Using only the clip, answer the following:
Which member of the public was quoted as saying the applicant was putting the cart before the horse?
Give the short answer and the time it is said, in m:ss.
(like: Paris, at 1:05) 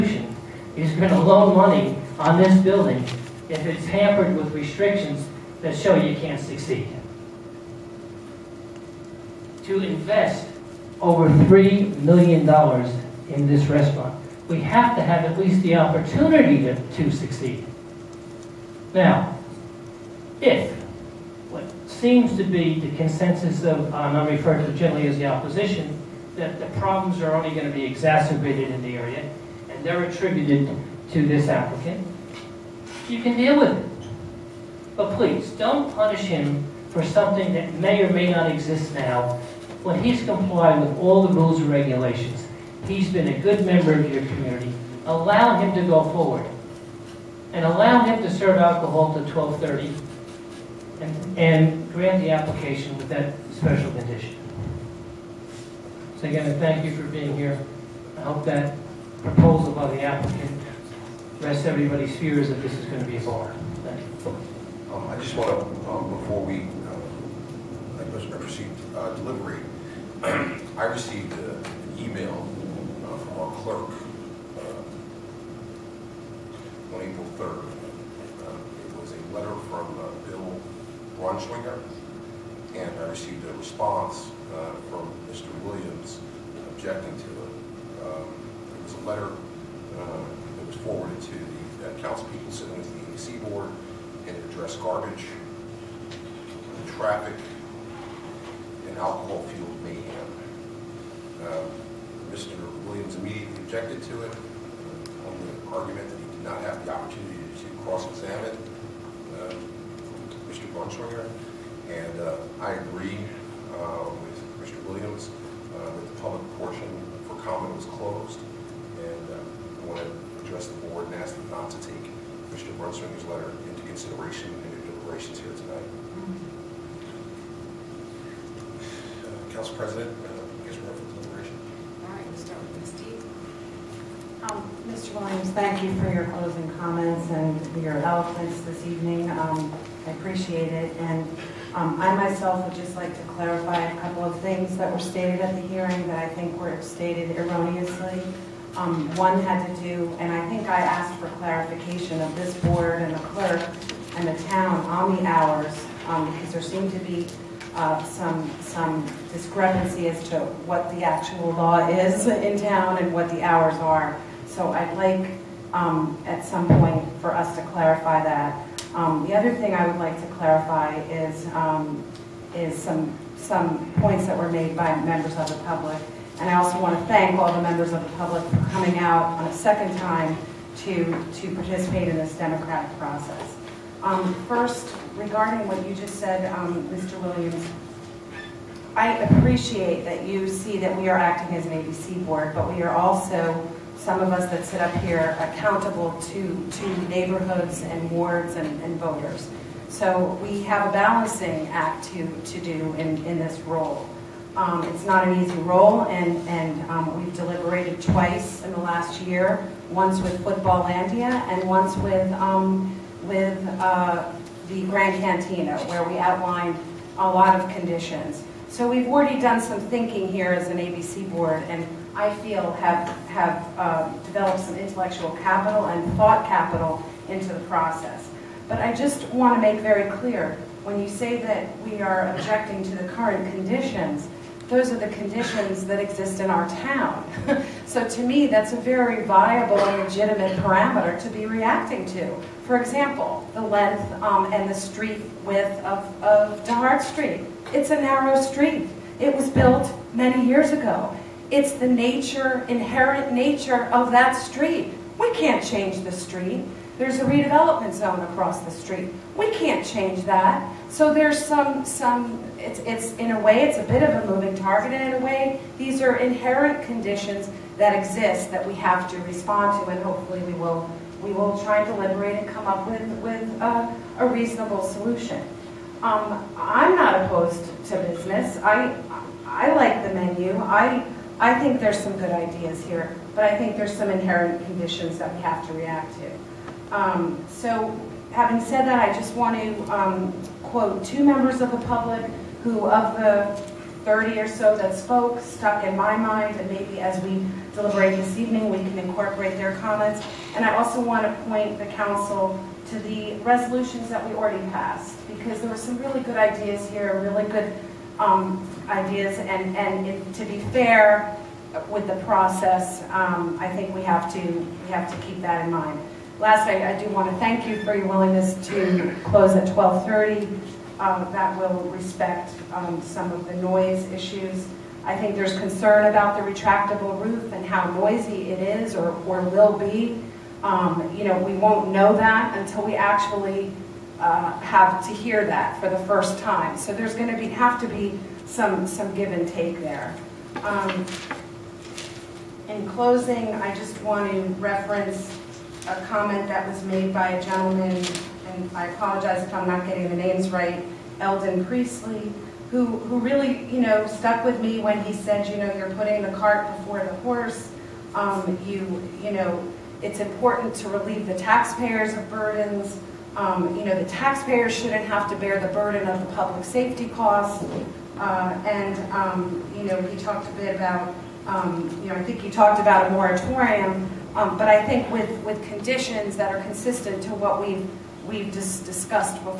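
Eldon Priestley, at 5:51.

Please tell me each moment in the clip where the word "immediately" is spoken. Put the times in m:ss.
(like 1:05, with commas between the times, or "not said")
1:43.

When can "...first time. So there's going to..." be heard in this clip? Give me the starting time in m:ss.
5:36.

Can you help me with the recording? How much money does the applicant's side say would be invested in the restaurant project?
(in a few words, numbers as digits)
over $3 million.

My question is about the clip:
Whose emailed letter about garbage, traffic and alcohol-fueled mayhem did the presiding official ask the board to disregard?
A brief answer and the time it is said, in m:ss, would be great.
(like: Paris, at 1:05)
Bill Braunschweiger, at 1:20.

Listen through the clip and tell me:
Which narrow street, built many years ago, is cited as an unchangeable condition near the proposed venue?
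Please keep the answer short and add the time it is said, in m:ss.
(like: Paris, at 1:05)
DeHart Street, at 4:06.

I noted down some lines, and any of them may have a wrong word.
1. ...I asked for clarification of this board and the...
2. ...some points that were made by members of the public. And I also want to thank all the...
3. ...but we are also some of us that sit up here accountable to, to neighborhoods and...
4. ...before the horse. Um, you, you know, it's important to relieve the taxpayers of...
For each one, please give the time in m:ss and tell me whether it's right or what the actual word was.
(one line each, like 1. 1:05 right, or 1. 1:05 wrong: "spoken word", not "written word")
1. 2:30 right
2. 2:53 right
3. 3:12 right
4. 5:56 right.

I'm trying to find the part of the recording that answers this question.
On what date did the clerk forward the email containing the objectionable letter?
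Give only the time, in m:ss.
1:17.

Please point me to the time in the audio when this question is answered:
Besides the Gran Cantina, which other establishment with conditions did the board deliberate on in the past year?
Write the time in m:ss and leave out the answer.
3:30.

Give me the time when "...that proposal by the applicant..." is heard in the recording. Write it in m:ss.
0:58.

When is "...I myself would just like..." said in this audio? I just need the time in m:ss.
2:22.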